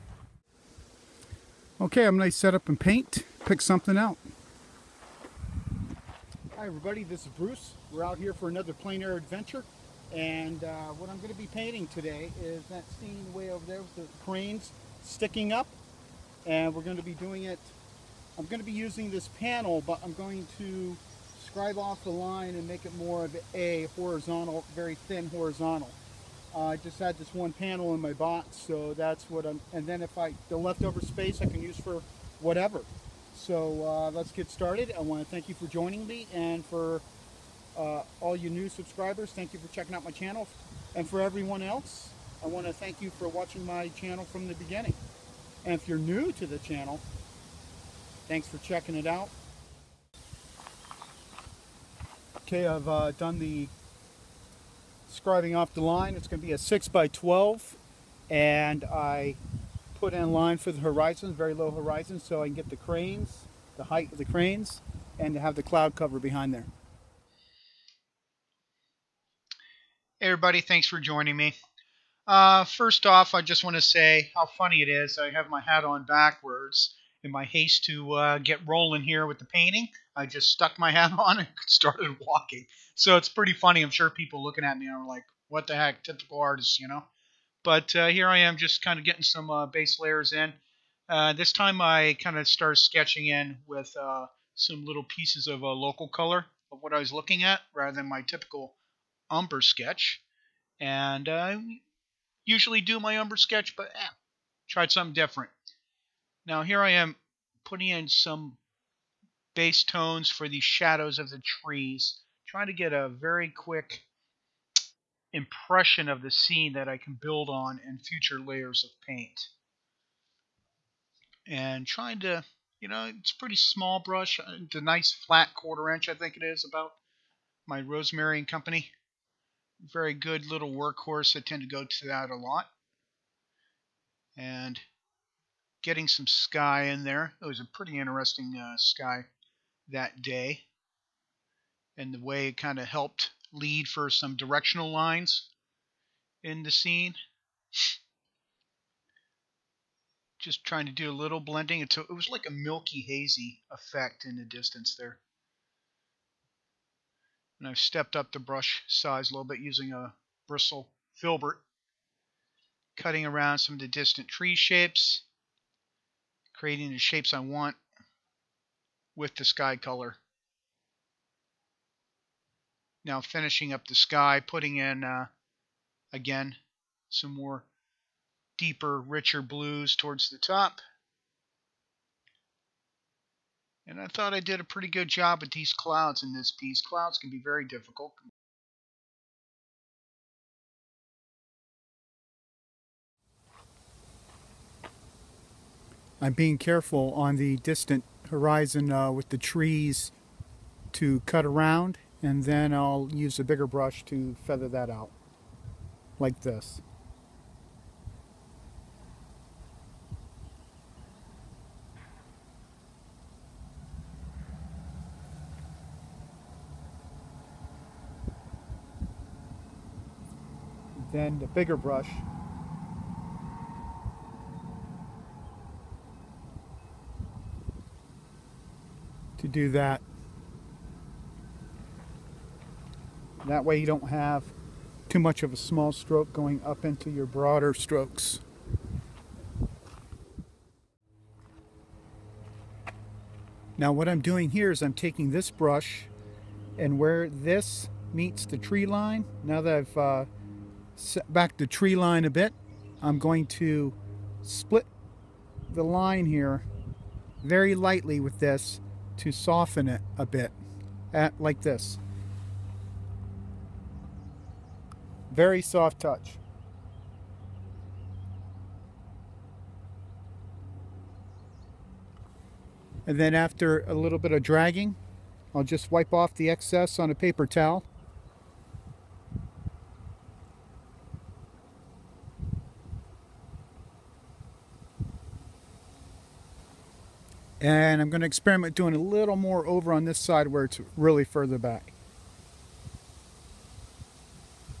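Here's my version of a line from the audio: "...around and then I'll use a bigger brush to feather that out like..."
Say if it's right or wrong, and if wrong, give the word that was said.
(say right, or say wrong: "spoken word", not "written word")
right.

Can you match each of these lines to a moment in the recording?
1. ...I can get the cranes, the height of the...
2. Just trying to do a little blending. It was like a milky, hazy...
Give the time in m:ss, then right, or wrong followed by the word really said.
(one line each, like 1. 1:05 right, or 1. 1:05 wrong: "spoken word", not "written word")
1. 1:02 right
2. 2:30 right.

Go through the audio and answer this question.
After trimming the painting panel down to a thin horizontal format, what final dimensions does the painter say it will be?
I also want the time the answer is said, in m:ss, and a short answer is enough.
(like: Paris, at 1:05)
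6 by 12, at 0:56.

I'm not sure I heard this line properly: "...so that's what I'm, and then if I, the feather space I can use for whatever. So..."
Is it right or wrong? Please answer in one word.
wrong.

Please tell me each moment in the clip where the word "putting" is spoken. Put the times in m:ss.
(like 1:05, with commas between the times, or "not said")
1:47, 2:54.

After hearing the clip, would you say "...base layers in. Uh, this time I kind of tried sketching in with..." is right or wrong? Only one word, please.
wrong.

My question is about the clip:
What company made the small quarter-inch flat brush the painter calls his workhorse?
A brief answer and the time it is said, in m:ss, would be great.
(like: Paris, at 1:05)
Rosemary and Company, at 2:07.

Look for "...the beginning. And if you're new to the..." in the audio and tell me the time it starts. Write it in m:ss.
0:44.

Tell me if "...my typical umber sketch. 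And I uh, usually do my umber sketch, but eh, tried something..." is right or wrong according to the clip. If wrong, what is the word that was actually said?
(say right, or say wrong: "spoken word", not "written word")
right.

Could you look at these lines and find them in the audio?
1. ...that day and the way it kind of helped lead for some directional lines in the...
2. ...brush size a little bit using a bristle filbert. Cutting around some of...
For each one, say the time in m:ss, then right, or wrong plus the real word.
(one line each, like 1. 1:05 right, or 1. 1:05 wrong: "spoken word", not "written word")
1. 2:19 right
2. 2:38 right.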